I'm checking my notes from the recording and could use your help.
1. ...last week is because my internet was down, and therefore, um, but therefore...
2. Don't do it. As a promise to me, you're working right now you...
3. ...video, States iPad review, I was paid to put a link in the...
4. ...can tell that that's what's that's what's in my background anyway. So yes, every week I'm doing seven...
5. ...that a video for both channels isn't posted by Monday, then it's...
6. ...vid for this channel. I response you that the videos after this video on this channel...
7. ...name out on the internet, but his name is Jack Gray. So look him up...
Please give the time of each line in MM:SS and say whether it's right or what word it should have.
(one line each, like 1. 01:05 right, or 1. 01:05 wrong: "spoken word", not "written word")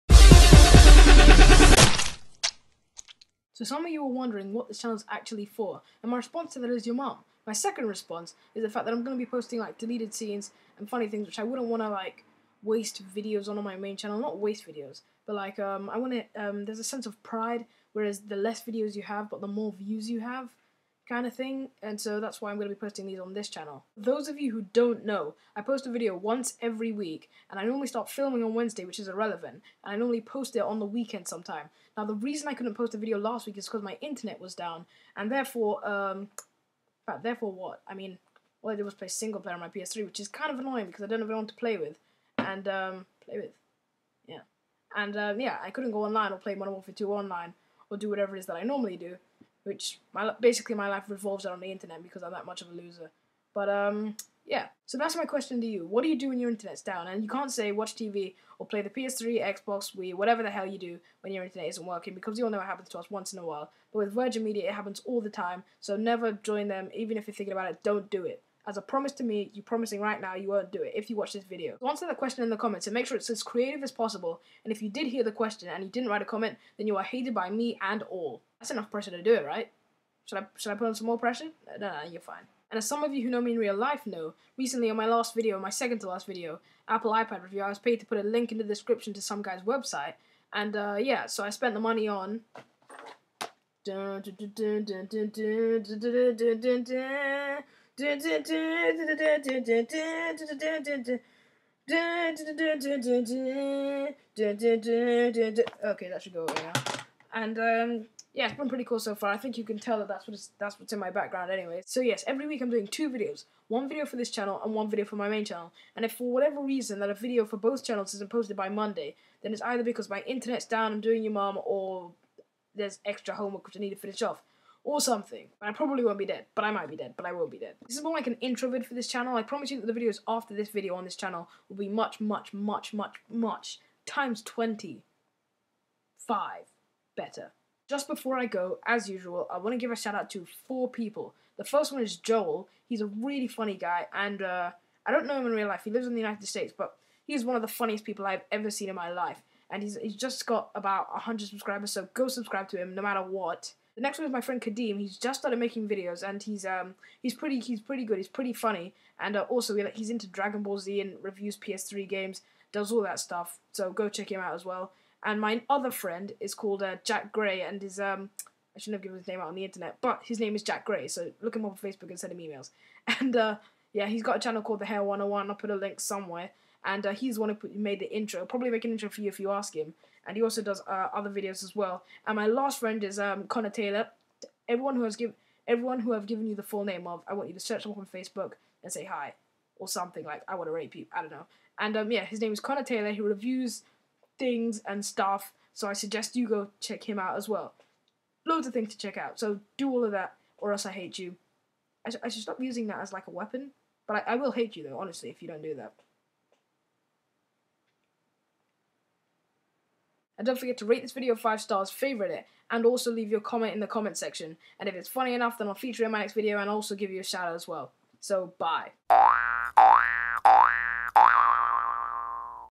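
1. 00:33 right
2. 01:07 wrong: "promising", not "working"
3. 01:26 wrong: "Apple", not "States"
4. 01:49 wrong: "two", not "seven"
5. 01:56 right
6. 02:08 wrong: "promise", not "response"
7. 02:49 right.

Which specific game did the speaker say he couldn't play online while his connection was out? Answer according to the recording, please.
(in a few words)
Modern Warfare 2.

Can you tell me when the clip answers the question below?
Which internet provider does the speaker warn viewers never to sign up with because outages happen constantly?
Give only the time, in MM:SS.
01:04.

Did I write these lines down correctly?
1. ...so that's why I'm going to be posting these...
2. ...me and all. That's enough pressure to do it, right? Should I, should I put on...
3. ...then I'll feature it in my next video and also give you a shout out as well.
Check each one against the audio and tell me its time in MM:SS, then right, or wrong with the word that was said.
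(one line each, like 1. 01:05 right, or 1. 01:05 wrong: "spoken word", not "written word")
1. 00:21 right
2. 01:17 right
3. 03:35 right.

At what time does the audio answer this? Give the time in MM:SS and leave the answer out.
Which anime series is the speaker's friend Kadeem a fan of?
02:40.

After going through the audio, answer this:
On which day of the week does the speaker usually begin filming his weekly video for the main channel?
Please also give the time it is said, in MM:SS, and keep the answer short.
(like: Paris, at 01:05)
Wednesday, at 00:28.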